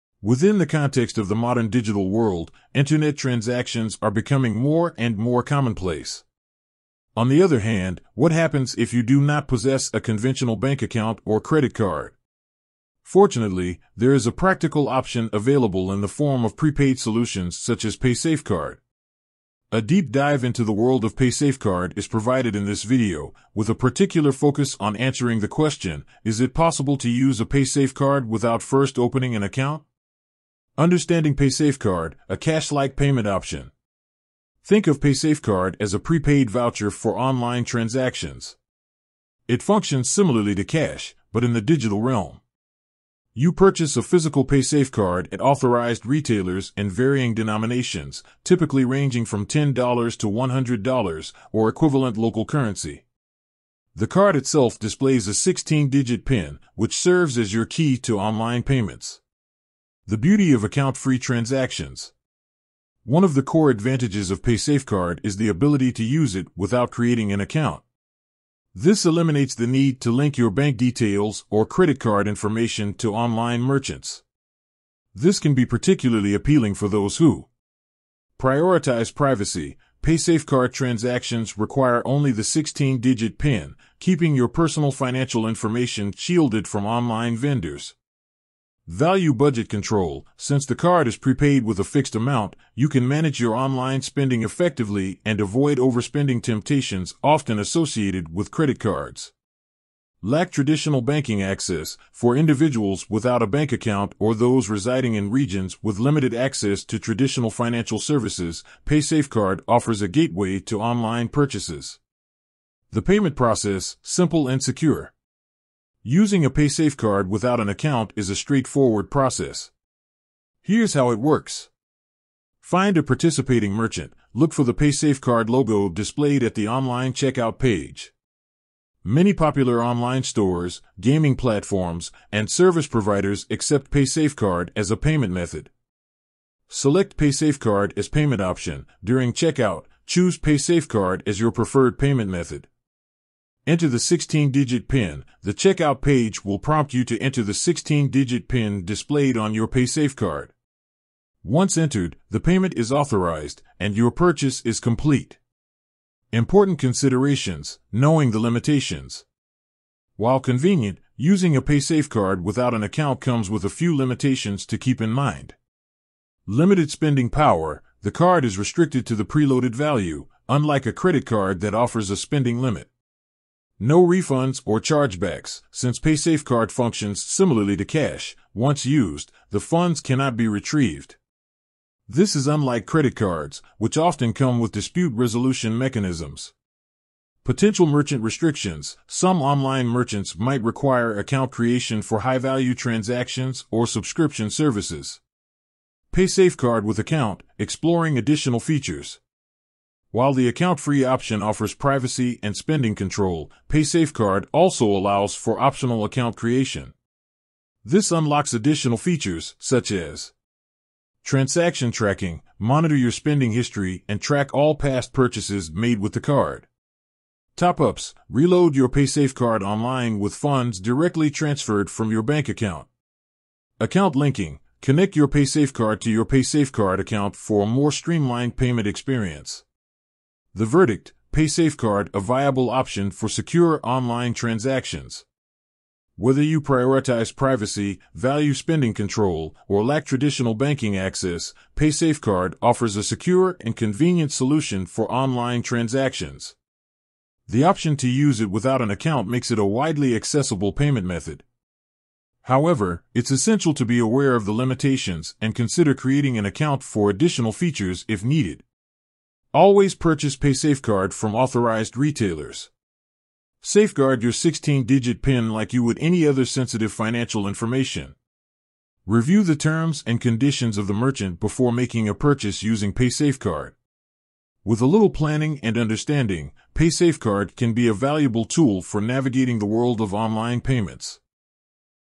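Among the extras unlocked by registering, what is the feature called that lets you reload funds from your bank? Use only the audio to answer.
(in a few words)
Top ups.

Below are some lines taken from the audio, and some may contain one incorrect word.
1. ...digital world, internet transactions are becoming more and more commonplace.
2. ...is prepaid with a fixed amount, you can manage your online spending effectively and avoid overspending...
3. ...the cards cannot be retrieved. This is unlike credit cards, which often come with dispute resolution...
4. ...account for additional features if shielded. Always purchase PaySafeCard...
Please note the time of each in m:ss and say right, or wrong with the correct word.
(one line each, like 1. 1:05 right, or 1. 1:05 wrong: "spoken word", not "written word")
1. 0:01 right
2. 1:31 right
3. 2:59 wrong: "funds", not "cards"
4. 4:16 wrong: "needed", not "shielded".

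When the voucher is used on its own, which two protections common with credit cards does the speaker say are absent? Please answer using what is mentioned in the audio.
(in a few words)
Refunds or chargebacks.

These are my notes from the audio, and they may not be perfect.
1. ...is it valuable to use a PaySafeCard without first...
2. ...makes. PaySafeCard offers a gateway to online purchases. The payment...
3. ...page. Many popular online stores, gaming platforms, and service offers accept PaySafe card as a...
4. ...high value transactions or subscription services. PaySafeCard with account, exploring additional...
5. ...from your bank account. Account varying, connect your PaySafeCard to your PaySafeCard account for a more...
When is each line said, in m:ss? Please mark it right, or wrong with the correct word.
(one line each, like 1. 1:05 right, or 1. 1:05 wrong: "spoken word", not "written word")
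1. 0:26 wrong: "possible", not "valuable"
2. 1:47 wrong: "services", not "makes"
3. 2:07 wrong: "providers", not "offers"
4. 3:12 right
5. 3:41 wrong: "linking", not "varying".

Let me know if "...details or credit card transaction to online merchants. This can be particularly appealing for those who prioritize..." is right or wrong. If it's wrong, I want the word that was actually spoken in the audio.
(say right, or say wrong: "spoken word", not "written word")
wrong: "information", not "transaction".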